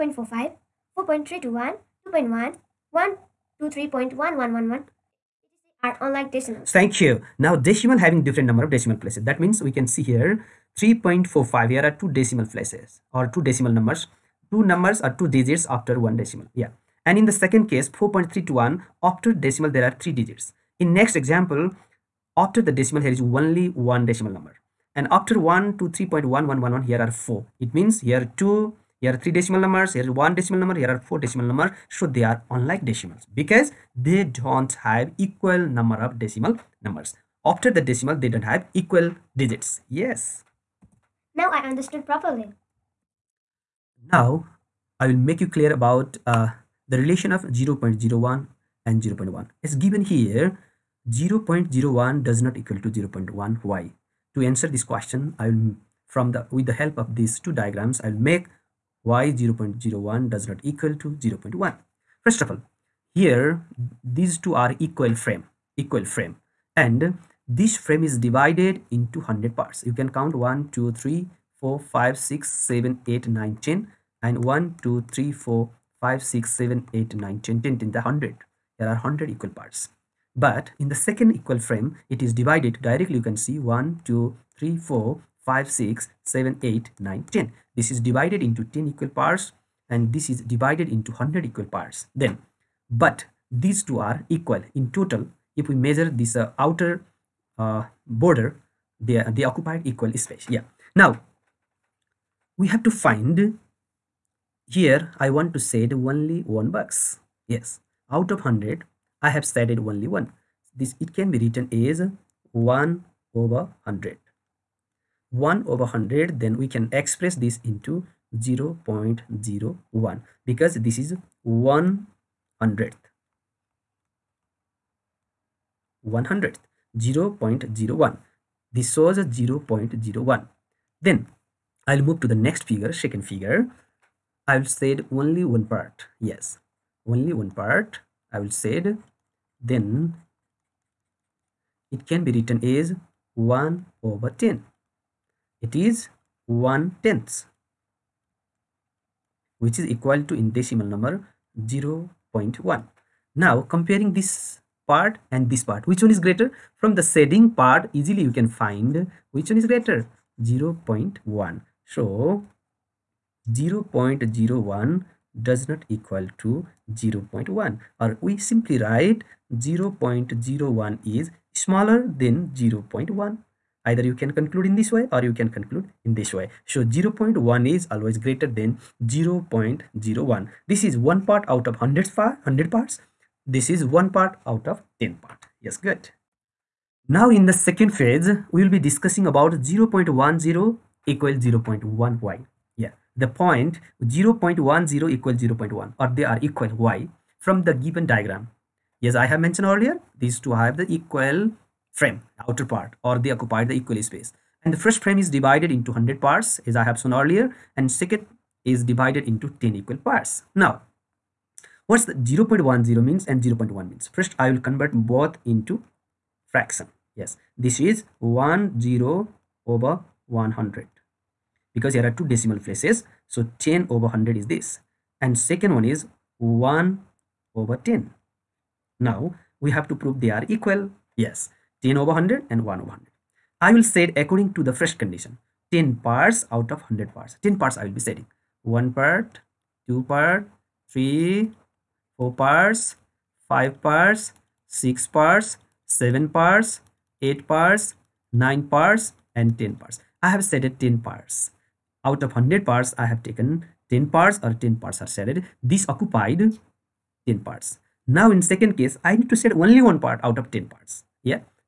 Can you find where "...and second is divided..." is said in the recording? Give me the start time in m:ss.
3:27.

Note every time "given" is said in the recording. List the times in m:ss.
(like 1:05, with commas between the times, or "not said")
0:49, 3:17.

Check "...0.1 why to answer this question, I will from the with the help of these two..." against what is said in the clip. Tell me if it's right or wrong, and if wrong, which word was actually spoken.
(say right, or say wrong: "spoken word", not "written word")
right.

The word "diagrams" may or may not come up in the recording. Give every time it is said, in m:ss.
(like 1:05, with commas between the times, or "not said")
0:57, 3:18.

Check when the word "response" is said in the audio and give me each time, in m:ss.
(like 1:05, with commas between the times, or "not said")
not said.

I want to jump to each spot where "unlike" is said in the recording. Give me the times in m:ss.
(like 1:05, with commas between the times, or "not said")
0:06, 0:32.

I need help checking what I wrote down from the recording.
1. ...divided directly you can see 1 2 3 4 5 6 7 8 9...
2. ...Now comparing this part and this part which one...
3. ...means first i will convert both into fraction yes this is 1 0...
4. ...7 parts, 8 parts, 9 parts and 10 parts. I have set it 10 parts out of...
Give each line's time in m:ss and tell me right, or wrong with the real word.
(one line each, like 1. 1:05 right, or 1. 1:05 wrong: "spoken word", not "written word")
1. 1:22 right
2. 2:33 right
3. 3:33 right
4. 4:05 right.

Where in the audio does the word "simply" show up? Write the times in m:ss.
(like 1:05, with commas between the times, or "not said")
2:48.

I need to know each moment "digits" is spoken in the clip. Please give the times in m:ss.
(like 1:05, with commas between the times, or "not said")
0:15, 0:20, 0:39.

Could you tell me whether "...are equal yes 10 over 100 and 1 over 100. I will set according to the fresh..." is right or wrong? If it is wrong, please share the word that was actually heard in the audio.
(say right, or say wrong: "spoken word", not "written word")
right.